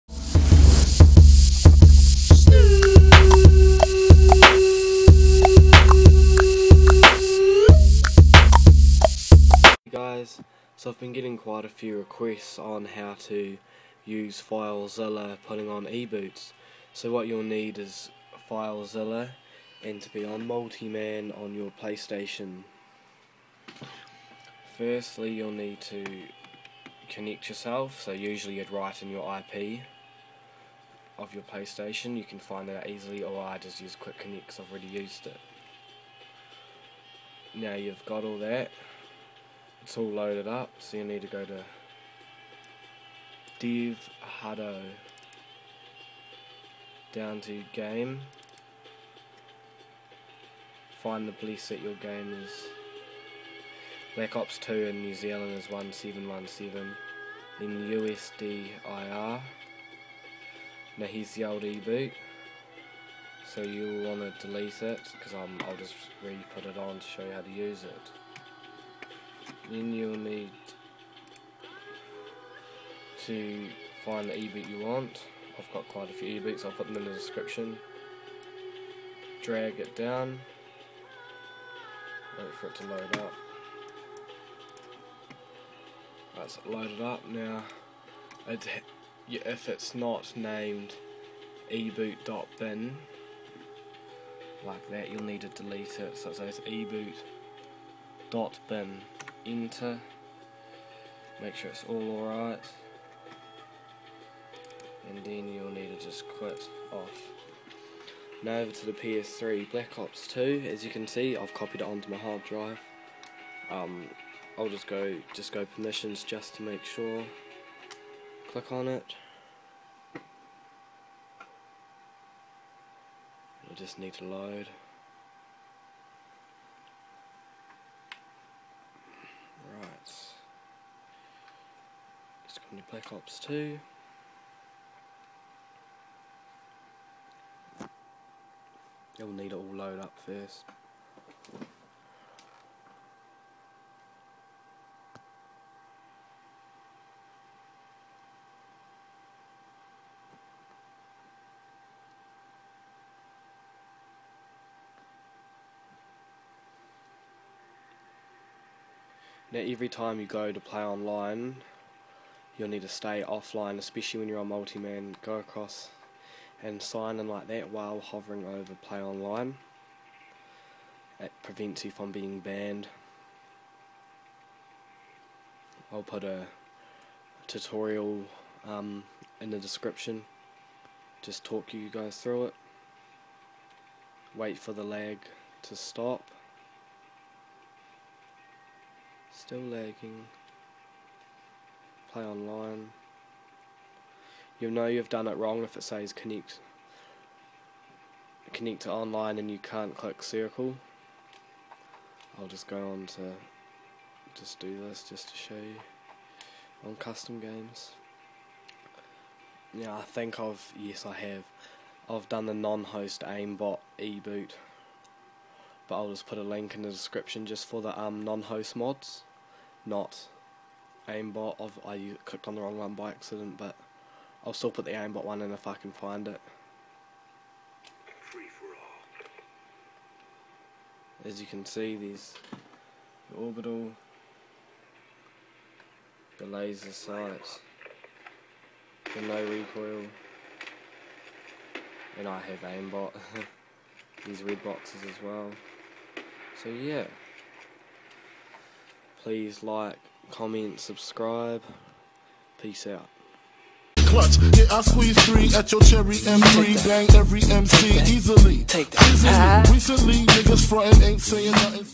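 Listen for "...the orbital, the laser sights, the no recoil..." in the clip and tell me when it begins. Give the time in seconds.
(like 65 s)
233 s.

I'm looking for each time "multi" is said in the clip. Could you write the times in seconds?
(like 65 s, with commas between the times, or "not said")
20 s, 164 s.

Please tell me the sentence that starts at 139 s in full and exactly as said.
You'll need it all load up first.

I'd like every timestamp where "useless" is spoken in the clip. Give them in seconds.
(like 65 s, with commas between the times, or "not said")
not said.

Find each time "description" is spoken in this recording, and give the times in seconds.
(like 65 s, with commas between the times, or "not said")
77 s, 179 s, 216 s.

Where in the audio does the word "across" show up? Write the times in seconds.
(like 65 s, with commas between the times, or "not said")
165 s.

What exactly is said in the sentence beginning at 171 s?
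It prevents you from being banned.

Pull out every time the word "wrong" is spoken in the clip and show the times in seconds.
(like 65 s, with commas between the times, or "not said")
195 s, 222 s.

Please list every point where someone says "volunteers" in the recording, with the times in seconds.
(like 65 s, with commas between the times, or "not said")
not said.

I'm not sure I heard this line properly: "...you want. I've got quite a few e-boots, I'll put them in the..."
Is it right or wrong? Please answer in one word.
right.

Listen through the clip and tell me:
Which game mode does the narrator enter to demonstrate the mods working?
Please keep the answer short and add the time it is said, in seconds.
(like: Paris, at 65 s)
custom games, at 206 s.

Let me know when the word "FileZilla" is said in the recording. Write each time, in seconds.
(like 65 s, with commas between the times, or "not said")
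14 s, 18 s.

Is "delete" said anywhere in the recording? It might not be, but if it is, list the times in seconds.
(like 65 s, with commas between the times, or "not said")
64 s, 95 s.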